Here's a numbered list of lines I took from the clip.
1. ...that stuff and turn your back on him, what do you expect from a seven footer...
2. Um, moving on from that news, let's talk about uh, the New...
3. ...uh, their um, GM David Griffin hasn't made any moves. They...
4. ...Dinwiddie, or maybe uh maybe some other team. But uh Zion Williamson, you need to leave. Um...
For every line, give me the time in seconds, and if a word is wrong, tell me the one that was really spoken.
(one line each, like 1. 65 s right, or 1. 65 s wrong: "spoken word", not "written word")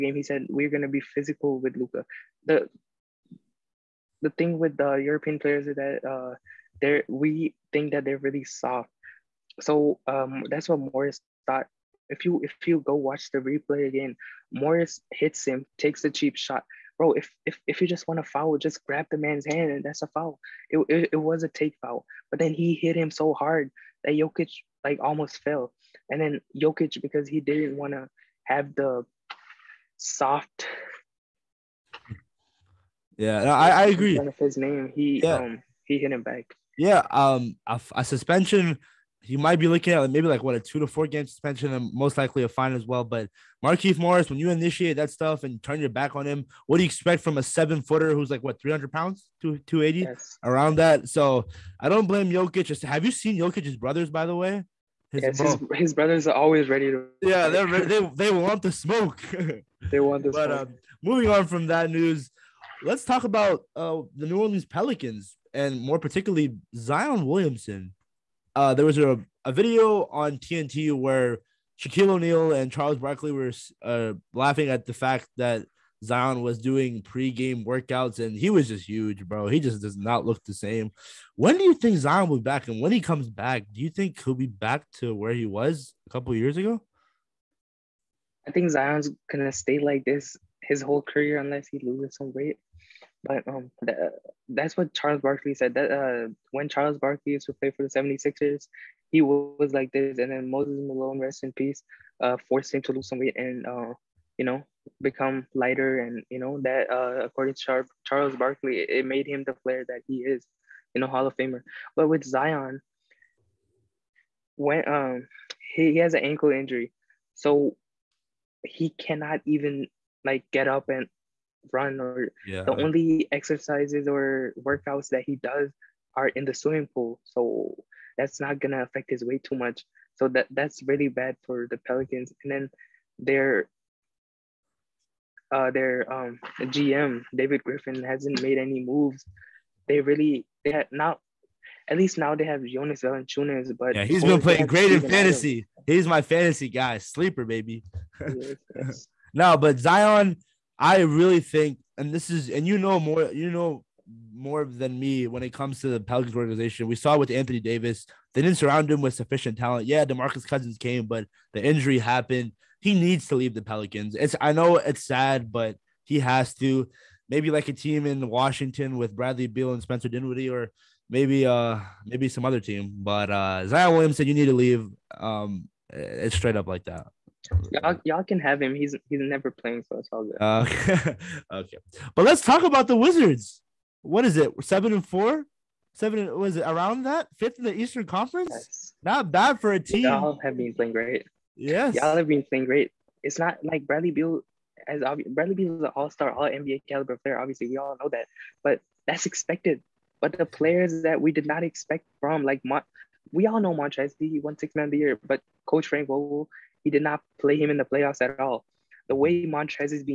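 1. 44 s right
2. 60 s right
3. 135 s right
4. 170 s right.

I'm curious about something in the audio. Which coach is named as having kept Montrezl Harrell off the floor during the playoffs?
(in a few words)
Frank Vogel.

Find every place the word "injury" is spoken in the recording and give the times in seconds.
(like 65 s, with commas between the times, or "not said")
116 s, 161 s.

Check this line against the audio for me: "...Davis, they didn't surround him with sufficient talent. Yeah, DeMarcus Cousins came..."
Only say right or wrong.
right.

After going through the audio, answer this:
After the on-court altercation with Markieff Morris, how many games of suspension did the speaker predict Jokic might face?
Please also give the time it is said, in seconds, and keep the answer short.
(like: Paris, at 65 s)
2 to 4 games, at 40 s.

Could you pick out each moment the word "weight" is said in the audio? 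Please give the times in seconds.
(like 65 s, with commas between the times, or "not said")
92 s, 103 s, 129 s.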